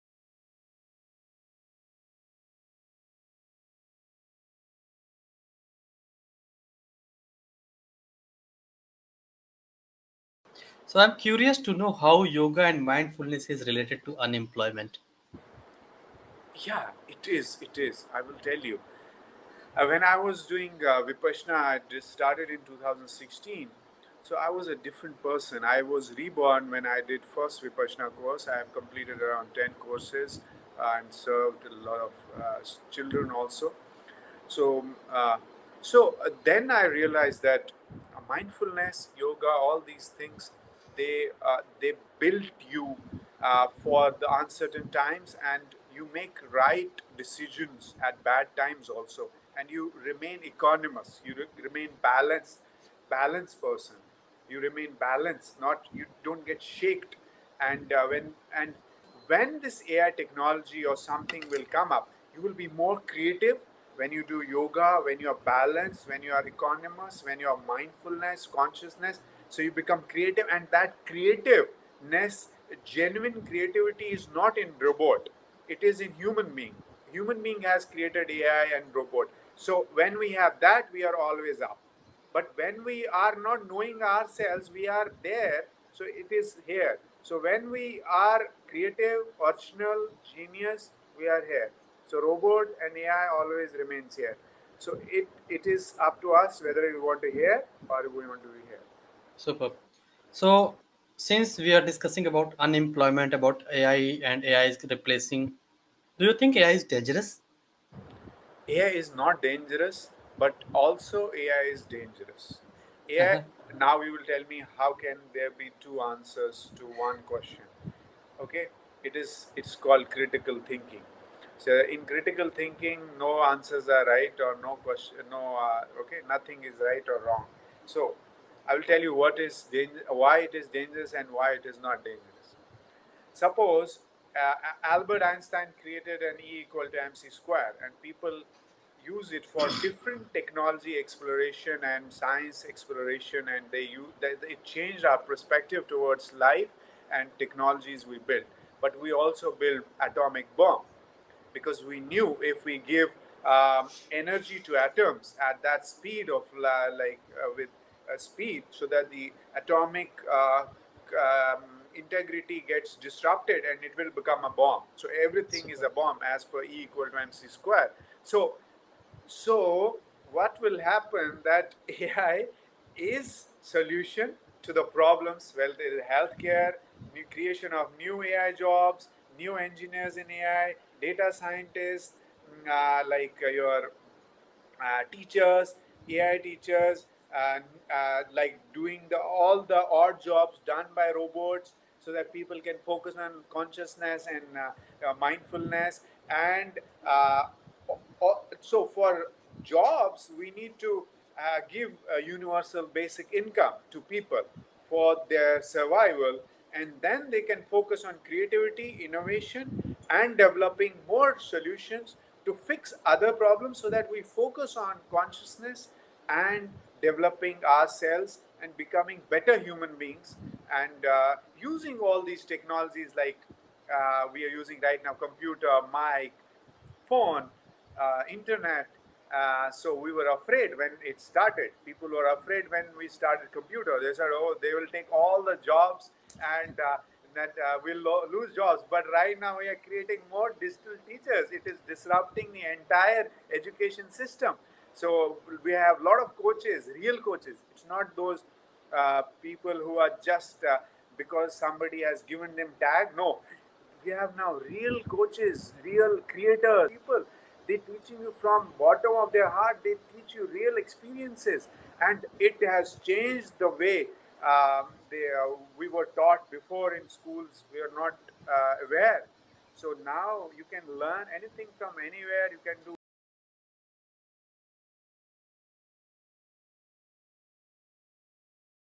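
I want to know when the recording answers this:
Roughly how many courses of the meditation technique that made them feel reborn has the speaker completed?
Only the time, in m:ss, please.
0:29.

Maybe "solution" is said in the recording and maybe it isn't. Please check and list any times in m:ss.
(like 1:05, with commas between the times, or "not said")
2:53, 3:31.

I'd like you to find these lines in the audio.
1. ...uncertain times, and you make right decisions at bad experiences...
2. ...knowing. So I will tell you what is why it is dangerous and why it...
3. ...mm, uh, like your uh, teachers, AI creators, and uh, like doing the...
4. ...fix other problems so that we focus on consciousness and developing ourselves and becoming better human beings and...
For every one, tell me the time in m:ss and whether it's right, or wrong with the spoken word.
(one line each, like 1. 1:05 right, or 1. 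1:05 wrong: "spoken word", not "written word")
1. 0:44 wrong: "times", not "experiences"
2. 2:07 wrong: "wrong", not "knowing"
3. 3:02 wrong: "teachers", not "creators"
4. 3:32 right.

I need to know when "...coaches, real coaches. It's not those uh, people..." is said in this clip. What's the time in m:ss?
4:06.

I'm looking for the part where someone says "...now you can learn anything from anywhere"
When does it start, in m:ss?
4:30.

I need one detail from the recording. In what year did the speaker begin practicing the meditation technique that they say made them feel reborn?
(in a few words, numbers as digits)
2016.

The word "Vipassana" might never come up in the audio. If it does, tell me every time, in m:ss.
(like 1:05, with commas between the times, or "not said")
0:21, 0:27.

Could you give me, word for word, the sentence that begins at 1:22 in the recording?
But when we are not knowing ourselves, we are there.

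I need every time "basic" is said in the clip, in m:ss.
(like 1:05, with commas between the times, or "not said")
3:22.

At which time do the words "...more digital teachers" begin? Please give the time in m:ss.
4:00.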